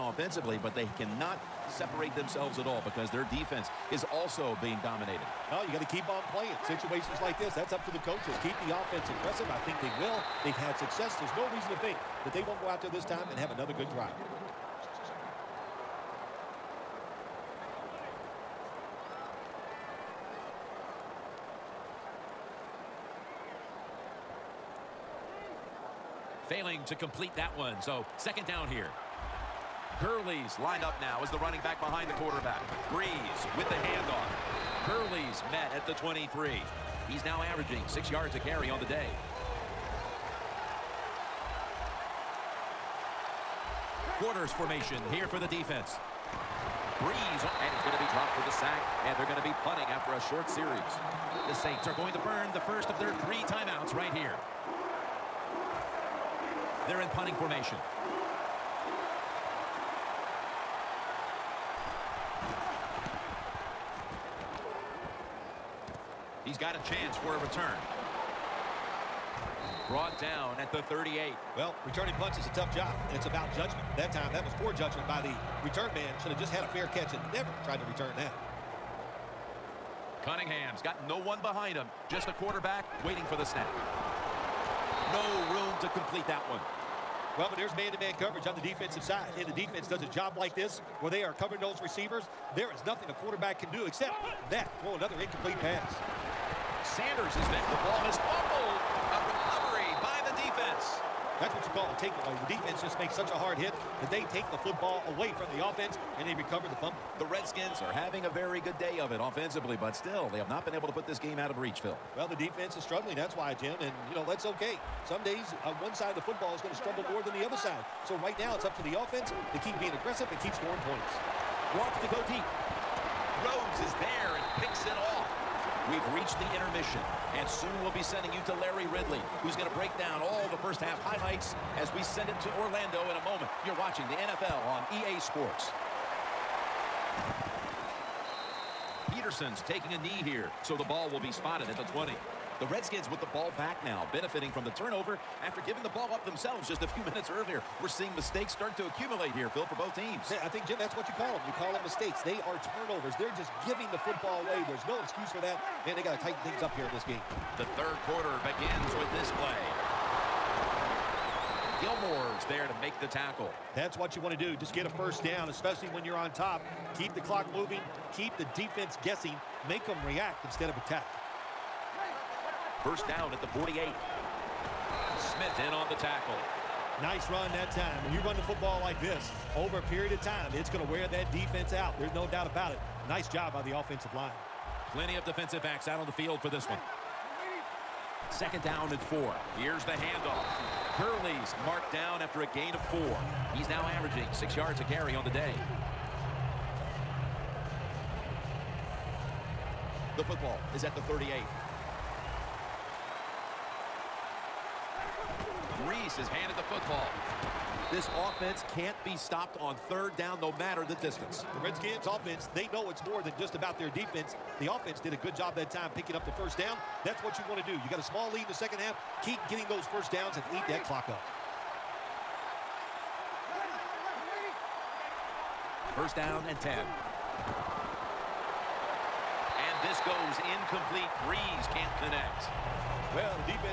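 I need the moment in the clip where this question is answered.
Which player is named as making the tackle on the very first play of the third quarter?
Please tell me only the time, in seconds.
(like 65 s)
161 s.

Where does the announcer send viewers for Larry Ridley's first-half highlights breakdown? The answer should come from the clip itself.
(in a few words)
Orlando.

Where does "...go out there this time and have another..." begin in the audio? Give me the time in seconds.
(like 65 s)
12 s.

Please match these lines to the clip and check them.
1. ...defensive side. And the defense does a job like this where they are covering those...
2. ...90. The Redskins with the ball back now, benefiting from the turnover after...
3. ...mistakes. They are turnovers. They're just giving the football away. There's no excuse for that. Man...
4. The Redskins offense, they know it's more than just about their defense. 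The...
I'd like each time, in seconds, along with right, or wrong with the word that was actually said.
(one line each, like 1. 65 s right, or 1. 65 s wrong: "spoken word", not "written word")
1. 88 s right
2. 141 s wrong: "20", not "90"
3. 151 s right
4. 211 s right.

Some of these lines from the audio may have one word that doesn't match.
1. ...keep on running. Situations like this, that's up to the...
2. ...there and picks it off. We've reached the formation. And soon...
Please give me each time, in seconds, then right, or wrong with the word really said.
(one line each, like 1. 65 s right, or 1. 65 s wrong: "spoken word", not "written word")
1. 5 s wrong: "playing", not "running"
2. 124 s wrong: "intermission", not "formation".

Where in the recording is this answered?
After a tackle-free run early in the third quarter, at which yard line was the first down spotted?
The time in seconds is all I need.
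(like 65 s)
173 s.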